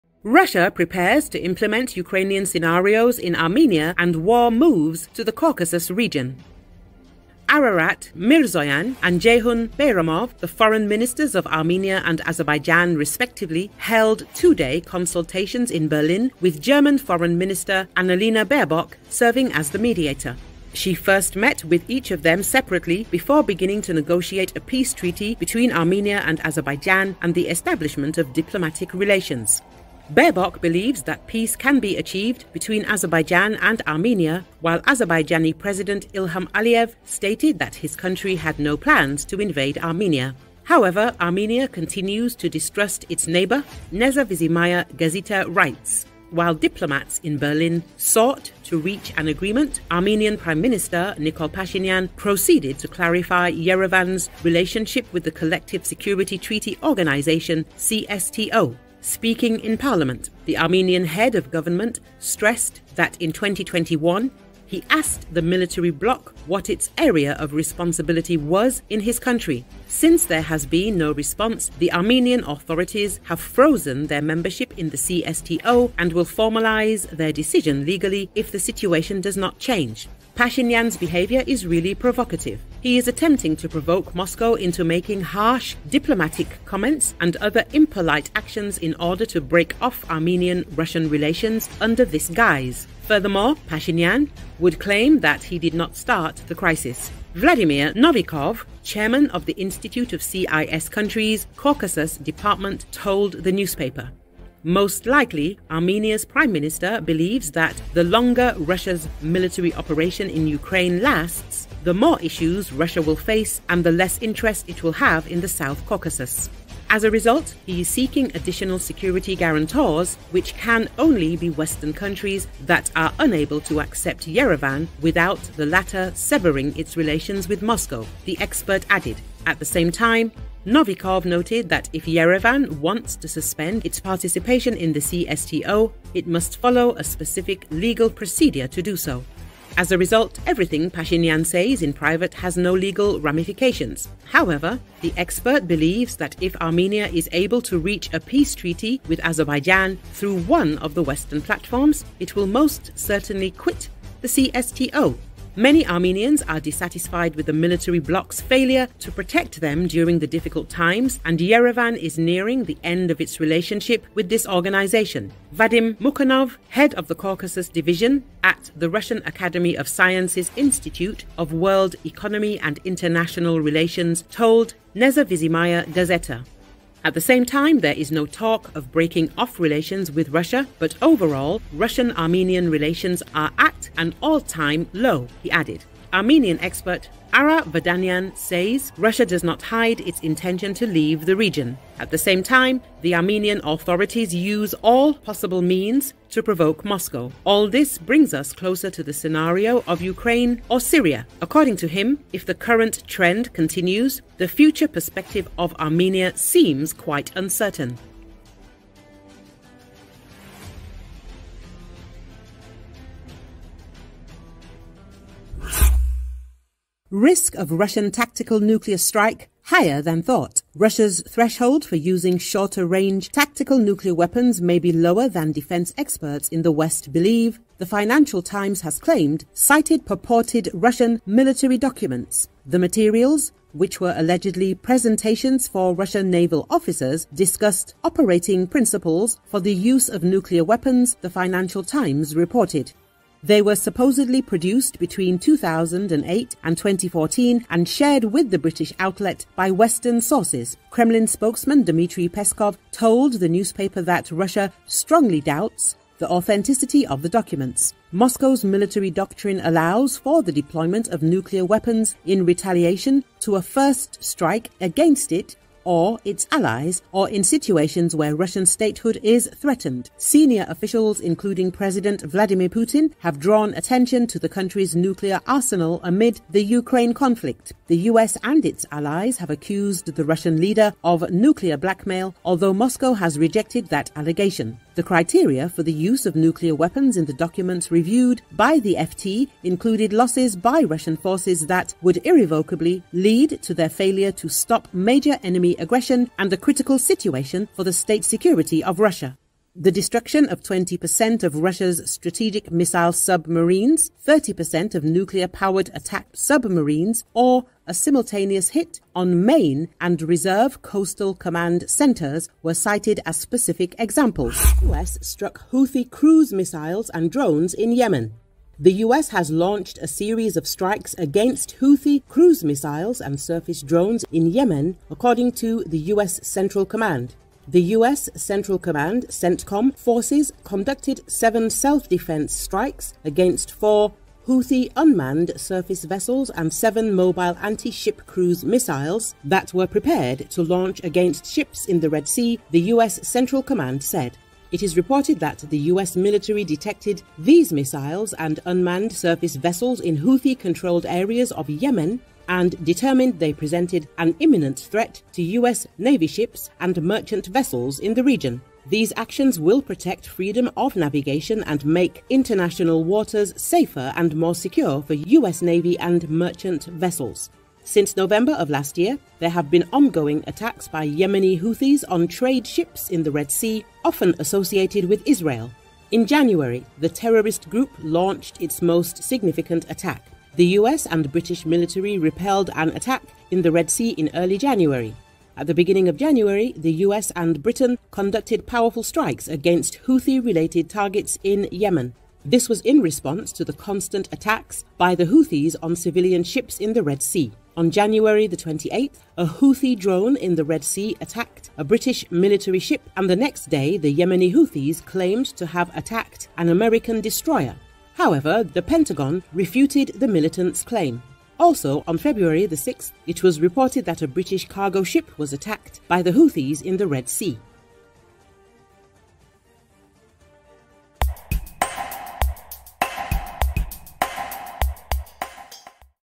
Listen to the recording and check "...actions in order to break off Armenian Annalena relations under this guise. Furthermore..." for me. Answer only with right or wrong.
wrong.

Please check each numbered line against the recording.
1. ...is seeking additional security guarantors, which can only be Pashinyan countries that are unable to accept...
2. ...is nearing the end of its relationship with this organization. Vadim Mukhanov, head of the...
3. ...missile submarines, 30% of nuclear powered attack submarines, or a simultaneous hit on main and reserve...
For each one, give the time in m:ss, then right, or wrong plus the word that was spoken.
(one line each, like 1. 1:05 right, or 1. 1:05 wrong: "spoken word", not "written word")
1. 1:57 wrong: "Western", not "Pashinyan"
2. 2:41 right
3. 5:02 right.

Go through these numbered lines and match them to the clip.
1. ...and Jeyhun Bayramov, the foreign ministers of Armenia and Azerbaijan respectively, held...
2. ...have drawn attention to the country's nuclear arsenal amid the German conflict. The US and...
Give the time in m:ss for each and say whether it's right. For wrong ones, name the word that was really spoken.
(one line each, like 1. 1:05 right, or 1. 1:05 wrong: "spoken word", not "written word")
1. 0:09 right
2. 4:33 wrong: "Ukraine", not "German".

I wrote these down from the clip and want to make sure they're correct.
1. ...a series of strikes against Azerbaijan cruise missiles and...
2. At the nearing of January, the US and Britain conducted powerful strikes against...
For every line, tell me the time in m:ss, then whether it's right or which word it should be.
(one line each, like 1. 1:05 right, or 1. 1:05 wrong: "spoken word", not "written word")
1. 5:19 wrong: "Houthi", not "Azerbaijan"
2. 6:25 wrong: "beginning", not "nearing".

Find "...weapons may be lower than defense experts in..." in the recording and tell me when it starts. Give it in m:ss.
3:44.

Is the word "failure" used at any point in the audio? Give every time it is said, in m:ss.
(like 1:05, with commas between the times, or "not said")
2:38, 4:53.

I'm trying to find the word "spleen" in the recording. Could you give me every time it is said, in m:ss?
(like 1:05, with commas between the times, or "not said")
not said.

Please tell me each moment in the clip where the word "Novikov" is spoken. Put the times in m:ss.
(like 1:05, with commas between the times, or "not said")
1:37, 2:10.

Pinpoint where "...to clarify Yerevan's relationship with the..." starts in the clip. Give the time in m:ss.
0:52.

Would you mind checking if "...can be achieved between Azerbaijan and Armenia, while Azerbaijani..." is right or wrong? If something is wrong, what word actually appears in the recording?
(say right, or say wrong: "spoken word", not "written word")
right.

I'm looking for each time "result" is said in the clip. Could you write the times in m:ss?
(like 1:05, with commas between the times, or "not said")
1:57, 2:19.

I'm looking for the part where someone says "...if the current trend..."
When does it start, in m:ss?
3:22.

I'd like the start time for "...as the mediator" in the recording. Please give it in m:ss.
0:19.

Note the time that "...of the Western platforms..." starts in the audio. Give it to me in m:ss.
2:30.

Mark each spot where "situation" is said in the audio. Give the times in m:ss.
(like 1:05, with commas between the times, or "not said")
1:18, 4:27, 4:56.